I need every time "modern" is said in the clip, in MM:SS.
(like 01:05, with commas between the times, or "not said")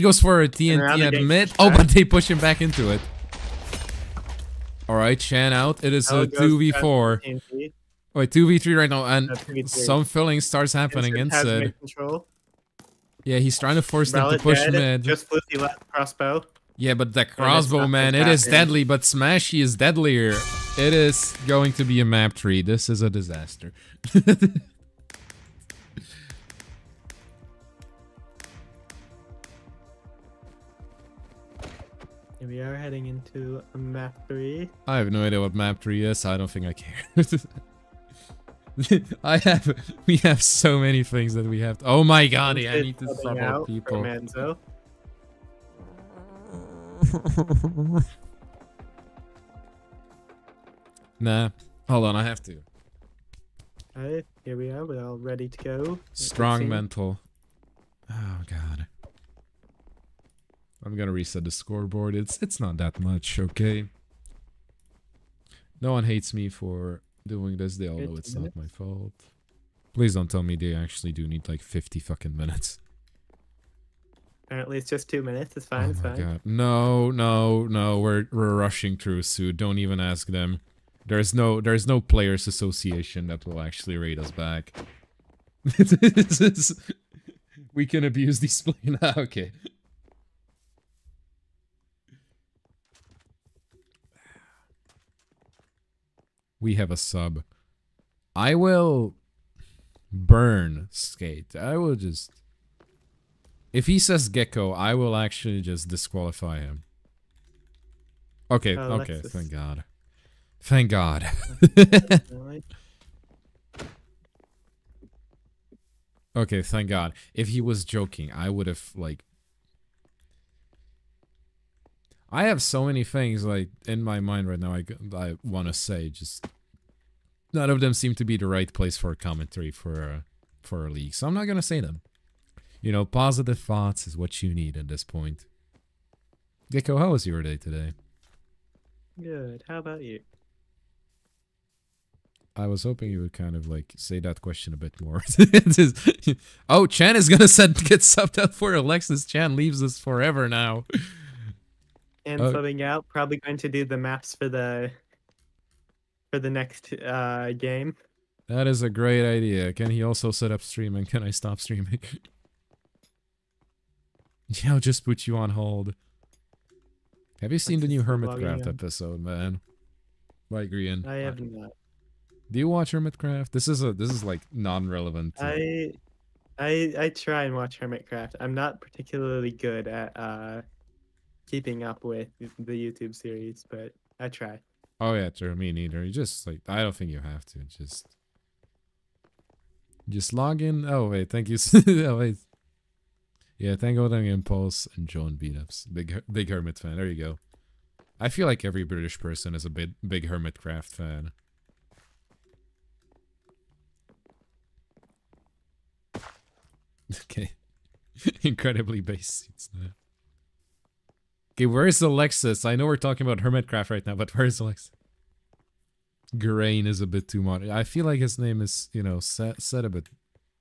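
03:37.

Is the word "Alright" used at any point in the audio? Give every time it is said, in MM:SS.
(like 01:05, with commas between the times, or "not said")
00:04, 00:53.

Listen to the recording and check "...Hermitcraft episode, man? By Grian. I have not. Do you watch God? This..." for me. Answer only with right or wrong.
wrong.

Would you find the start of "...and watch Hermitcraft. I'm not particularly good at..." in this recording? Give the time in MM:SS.
02:57.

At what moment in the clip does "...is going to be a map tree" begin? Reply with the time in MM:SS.
00:20.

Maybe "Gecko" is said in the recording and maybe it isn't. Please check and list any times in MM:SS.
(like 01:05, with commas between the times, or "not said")
01:44, 02:16.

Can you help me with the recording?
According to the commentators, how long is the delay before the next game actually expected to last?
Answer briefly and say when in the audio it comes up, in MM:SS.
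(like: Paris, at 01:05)
2 minutes, at 01:15.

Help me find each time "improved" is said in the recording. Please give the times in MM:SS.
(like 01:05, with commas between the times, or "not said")
not said.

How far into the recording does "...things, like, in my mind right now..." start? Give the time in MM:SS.
02:03.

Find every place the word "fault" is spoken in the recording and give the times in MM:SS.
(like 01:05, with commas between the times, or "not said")
01:08.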